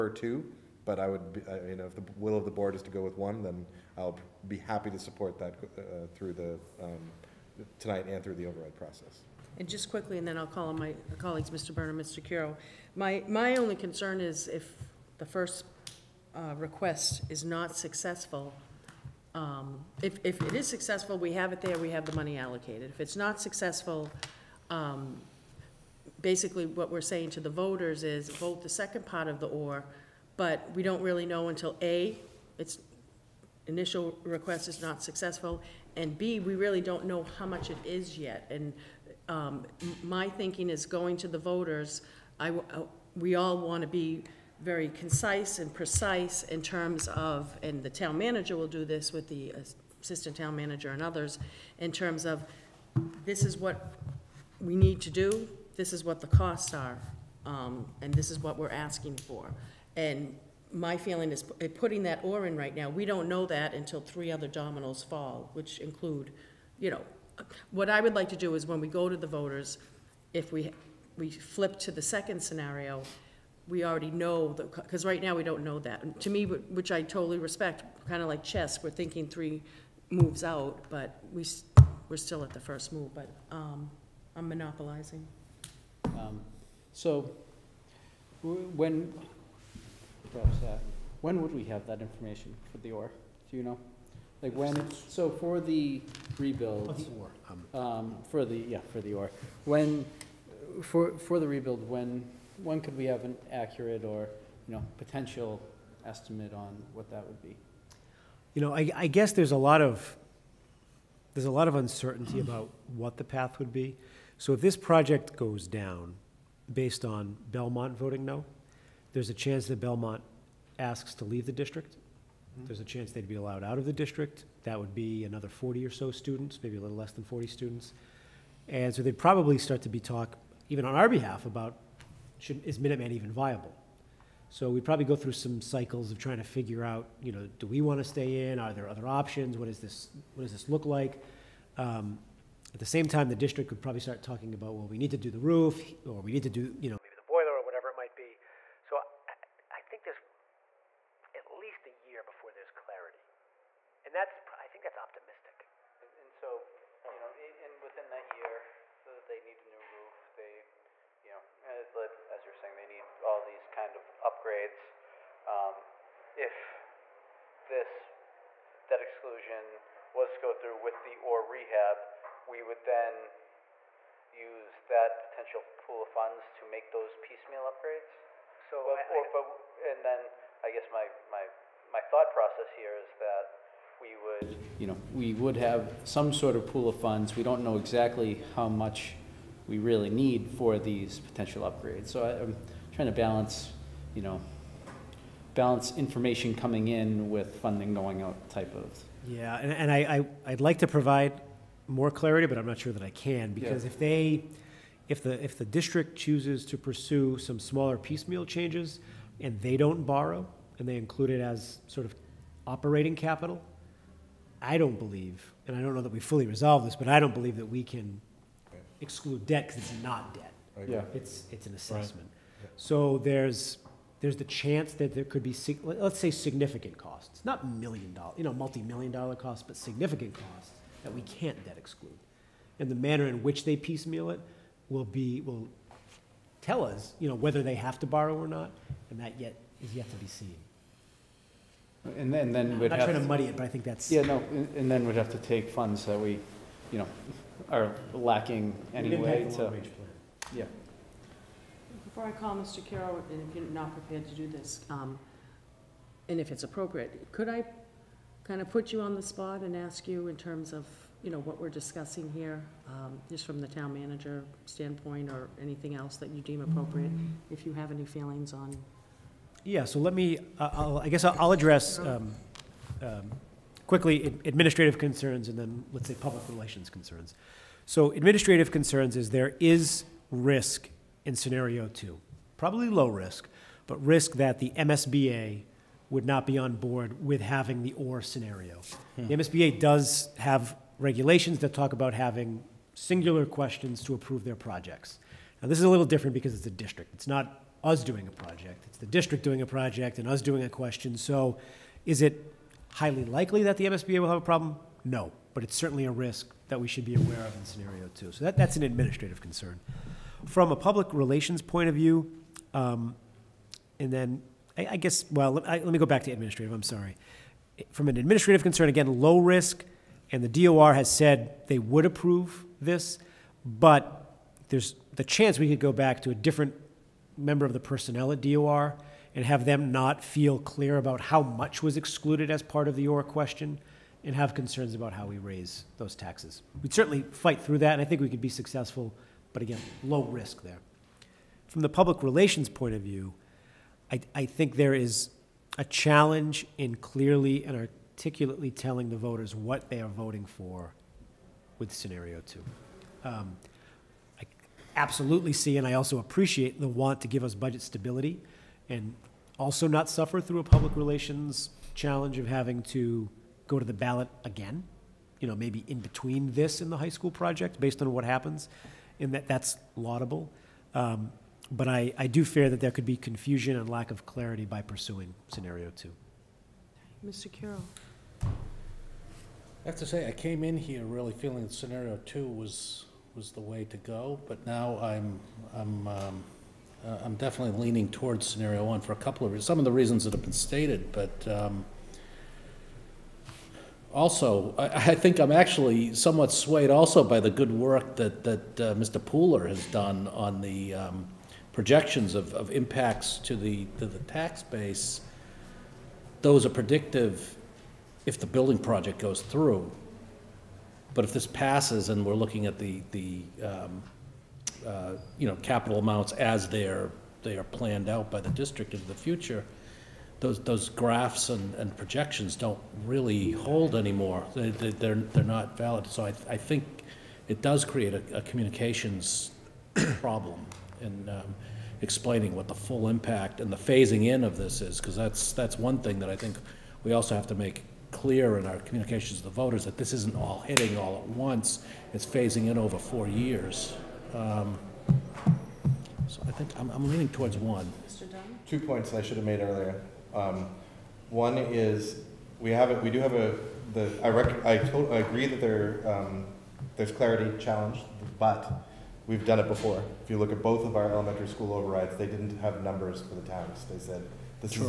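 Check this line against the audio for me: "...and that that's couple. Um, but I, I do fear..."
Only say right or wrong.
wrong.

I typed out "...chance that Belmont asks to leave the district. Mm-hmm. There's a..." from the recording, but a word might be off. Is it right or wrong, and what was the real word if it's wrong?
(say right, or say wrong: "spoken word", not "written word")
right.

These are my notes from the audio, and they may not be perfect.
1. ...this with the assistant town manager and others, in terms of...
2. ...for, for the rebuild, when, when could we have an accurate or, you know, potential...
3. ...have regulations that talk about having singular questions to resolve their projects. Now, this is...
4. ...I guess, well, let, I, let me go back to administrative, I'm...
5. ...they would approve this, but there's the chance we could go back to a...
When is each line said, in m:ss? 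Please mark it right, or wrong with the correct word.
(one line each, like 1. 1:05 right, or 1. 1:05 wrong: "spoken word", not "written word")
1. 0:48 right
2. 1:40 right
3. 4:50 wrong: "approve", not "resolve"
4. 5:14 right
5. 5:21 right.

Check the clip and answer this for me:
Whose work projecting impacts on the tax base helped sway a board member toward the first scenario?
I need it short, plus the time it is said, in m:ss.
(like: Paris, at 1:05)
Mr. Pooler, at 6:38.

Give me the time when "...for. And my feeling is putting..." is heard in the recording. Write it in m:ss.
0:59.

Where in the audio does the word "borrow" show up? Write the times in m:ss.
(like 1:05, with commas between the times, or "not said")
3:30, 3:58.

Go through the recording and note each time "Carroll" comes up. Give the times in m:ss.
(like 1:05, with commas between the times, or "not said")
4:12.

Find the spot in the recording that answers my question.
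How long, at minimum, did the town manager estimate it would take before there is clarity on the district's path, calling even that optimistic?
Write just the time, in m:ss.
2:31.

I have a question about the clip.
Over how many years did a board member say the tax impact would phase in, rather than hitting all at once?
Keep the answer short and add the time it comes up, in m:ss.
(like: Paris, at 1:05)
4, at 7:22.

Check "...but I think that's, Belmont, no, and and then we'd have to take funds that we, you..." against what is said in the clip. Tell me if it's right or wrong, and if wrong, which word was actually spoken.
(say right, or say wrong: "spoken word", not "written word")
wrong: "Yeah", not "Belmont".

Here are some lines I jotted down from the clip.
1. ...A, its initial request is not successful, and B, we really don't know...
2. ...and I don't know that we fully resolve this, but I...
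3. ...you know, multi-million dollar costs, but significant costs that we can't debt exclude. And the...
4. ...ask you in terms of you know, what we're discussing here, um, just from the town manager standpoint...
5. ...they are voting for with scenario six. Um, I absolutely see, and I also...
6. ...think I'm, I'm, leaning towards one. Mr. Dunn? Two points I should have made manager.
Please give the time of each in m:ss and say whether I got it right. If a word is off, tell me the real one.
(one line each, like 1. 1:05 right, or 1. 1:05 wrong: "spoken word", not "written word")
1. 0:31 right
2. 3:35 right
3. 3:48 right
4. 4:19 right
5. 5:49 wrong: "two", not "six"
6. 7:26 wrong: "earlier", not "manager".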